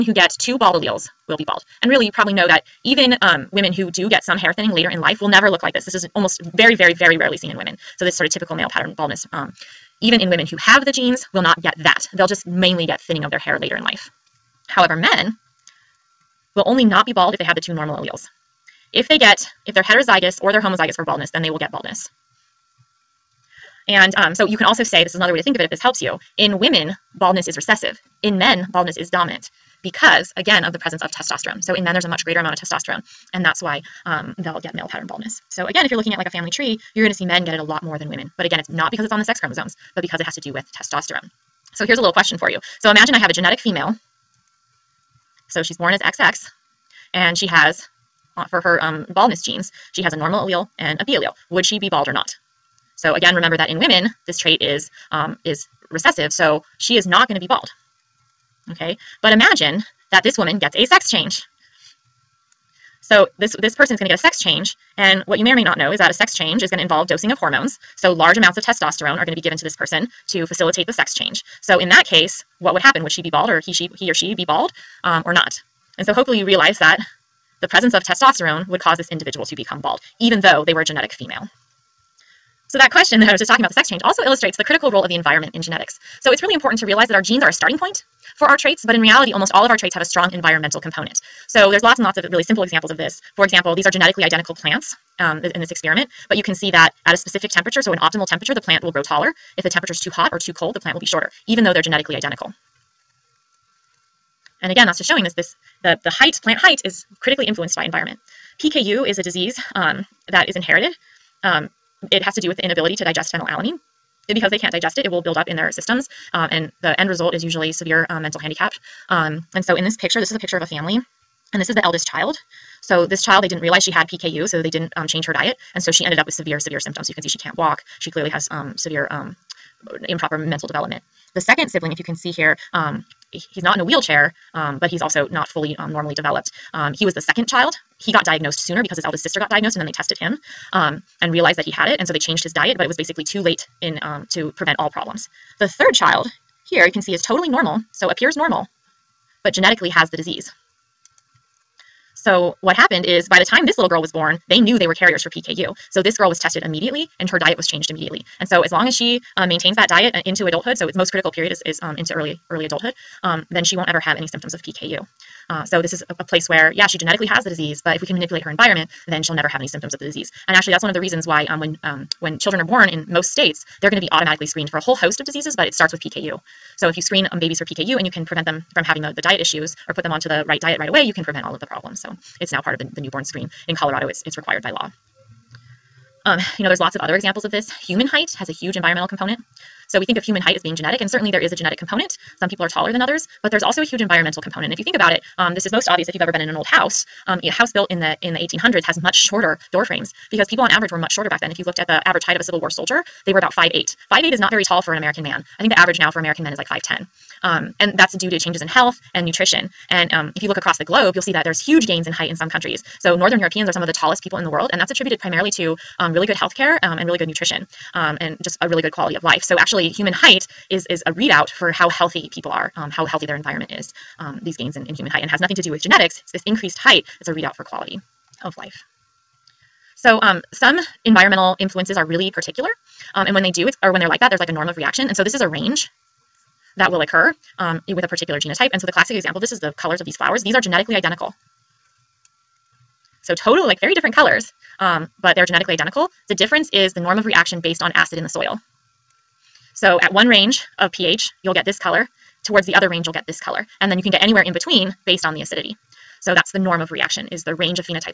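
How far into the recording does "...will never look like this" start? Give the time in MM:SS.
00:05.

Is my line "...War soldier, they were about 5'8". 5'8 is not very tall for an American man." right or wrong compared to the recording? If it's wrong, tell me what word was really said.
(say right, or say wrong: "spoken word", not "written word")
right.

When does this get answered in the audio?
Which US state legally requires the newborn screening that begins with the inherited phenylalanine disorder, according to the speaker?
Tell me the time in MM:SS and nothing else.
03:03.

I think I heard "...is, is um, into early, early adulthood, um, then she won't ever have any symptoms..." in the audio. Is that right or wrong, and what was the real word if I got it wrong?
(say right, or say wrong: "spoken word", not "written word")
right.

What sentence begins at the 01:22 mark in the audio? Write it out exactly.
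So that question that I was just talking about, the sex change, also illustrates the critical role of the environment in genetics.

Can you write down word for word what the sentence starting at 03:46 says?
It's this increased height It's a readout for quality of life.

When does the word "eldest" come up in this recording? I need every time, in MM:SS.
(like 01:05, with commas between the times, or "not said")
02:01, 02:19.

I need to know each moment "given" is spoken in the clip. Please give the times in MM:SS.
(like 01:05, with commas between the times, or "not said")
01:09.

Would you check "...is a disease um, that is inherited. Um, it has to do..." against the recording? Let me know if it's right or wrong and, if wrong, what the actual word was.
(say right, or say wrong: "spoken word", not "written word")
right.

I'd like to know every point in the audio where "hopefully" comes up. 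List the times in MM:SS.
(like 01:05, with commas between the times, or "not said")
01:16.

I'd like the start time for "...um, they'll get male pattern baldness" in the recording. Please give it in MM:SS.
00:34.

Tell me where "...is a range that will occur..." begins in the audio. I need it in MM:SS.
03:55.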